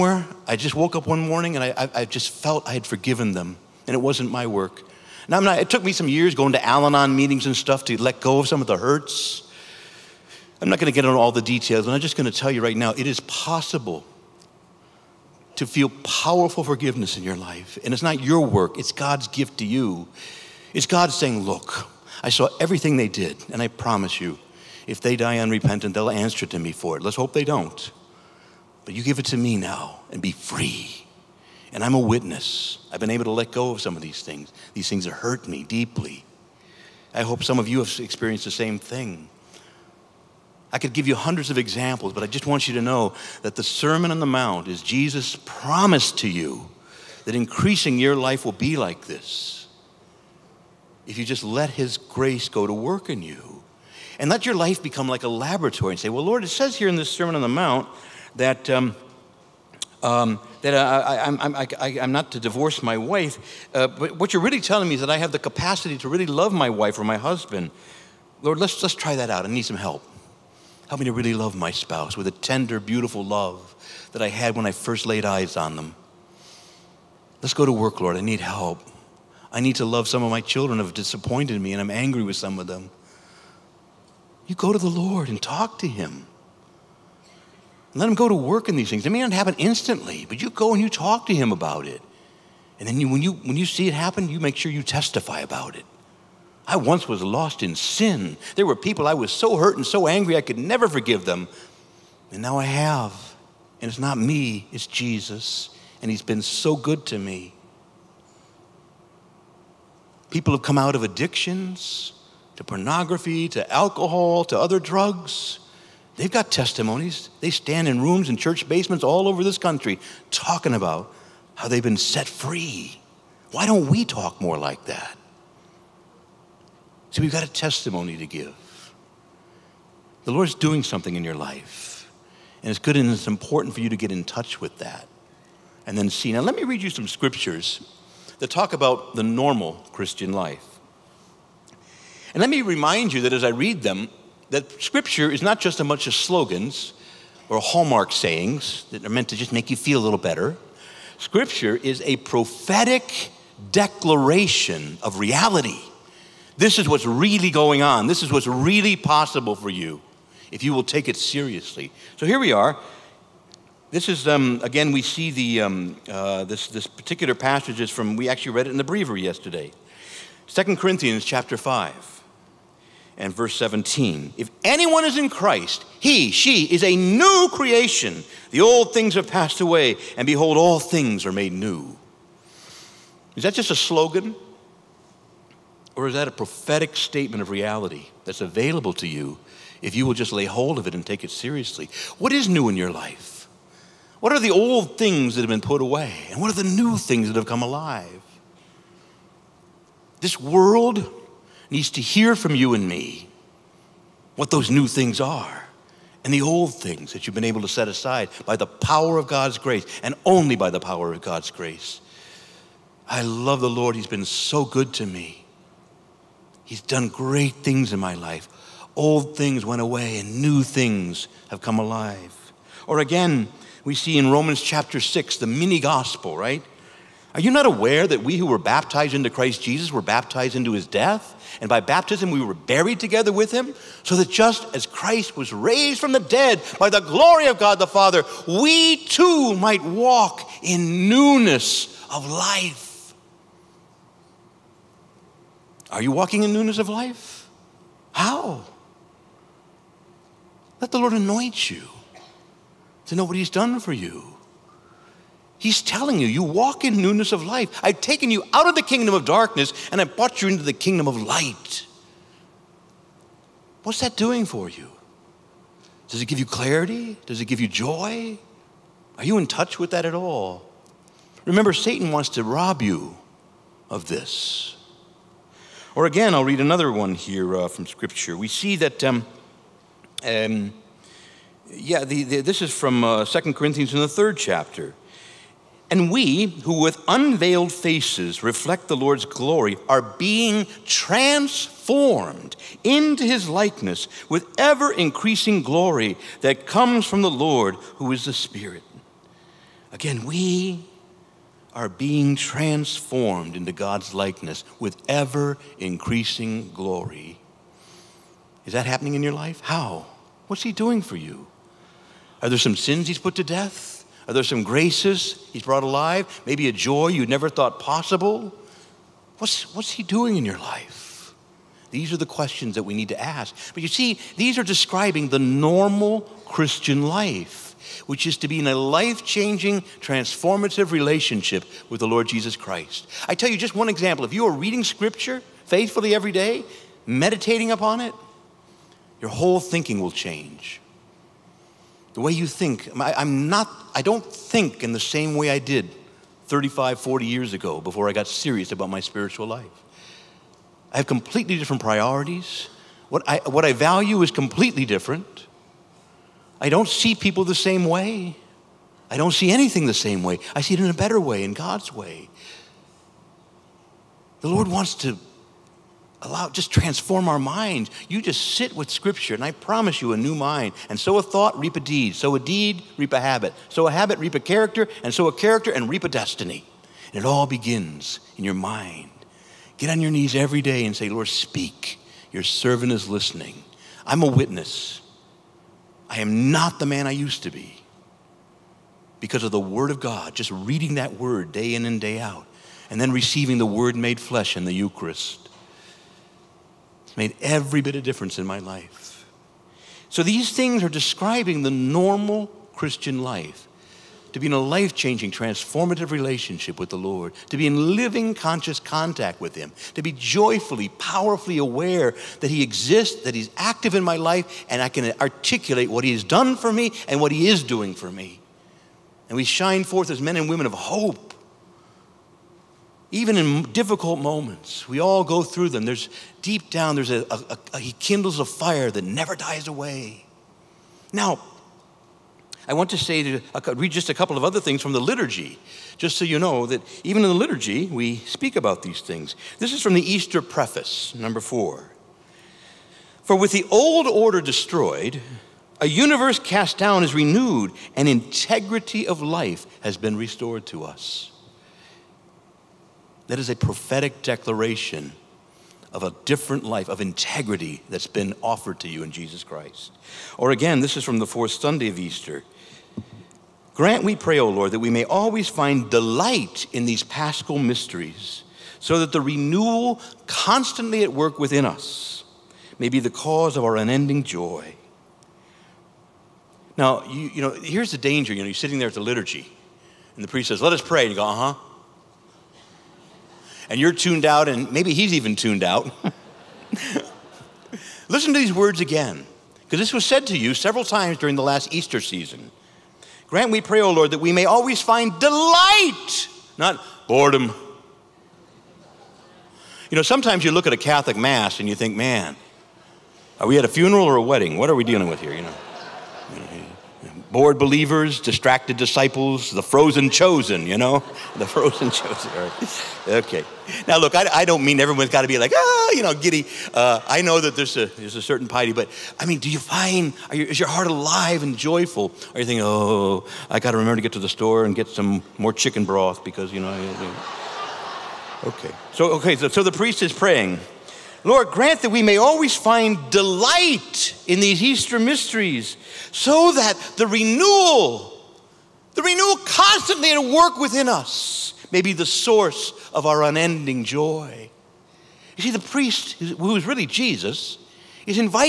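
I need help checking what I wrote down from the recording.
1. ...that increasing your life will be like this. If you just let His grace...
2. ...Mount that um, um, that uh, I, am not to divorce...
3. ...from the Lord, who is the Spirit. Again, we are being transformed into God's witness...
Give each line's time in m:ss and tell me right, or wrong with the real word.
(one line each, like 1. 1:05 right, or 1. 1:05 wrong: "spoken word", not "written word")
1. 0:47 right
2. 0:57 right
3. 4:57 wrong: "likeness", not "witness".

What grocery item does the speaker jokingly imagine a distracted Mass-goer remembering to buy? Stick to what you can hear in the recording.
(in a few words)
Chicken broth.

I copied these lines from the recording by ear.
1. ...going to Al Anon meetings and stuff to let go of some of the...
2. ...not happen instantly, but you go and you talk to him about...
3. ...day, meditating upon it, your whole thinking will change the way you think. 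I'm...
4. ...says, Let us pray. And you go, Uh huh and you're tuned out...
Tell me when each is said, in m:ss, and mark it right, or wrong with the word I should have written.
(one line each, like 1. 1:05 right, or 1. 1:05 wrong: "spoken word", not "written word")
1. 0:06 right
2. 1:29 right
3. 5:36 right
4. 8:00 right.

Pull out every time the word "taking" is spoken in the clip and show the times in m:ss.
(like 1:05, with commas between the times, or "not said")
not said.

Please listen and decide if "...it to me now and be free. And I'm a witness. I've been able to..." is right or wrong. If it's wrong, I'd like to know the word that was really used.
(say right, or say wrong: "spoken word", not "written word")
right.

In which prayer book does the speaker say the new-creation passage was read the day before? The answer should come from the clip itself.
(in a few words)
The breviary.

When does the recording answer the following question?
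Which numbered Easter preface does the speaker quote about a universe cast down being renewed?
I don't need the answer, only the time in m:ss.
7:21.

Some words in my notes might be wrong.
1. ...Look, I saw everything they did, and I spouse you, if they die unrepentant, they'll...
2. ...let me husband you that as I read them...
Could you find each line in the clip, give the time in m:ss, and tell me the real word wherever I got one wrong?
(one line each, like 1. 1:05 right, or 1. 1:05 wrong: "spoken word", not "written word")
1. 0:21 wrong: "promise", not "spouse"
2. 2:22 wrong: "remind", not "husband".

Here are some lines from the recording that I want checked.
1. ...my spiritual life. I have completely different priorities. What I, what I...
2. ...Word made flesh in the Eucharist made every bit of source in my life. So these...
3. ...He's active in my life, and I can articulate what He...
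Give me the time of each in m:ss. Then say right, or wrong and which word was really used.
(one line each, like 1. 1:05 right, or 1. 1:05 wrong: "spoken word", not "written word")
1. 5:48 right
2. 6:33 wrong: "difference", not "source"
3. 6:53 right.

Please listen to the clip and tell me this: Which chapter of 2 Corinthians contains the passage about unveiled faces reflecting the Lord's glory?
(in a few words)
Third chapter.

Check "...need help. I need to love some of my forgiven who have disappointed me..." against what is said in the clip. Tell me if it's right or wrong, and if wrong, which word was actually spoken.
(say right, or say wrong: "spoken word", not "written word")
wrong: "children", not "forgiven".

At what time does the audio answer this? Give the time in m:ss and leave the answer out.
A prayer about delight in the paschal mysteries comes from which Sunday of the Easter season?
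7:41.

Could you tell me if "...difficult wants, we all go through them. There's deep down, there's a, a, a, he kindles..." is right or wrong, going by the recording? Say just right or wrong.
wrong.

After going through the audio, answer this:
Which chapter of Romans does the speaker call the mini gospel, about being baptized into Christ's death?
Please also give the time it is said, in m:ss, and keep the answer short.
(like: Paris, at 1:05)
Chapter 6, at 3:44.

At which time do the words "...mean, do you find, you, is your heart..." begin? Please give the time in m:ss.
8:39.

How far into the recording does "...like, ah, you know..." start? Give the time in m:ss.
8:35.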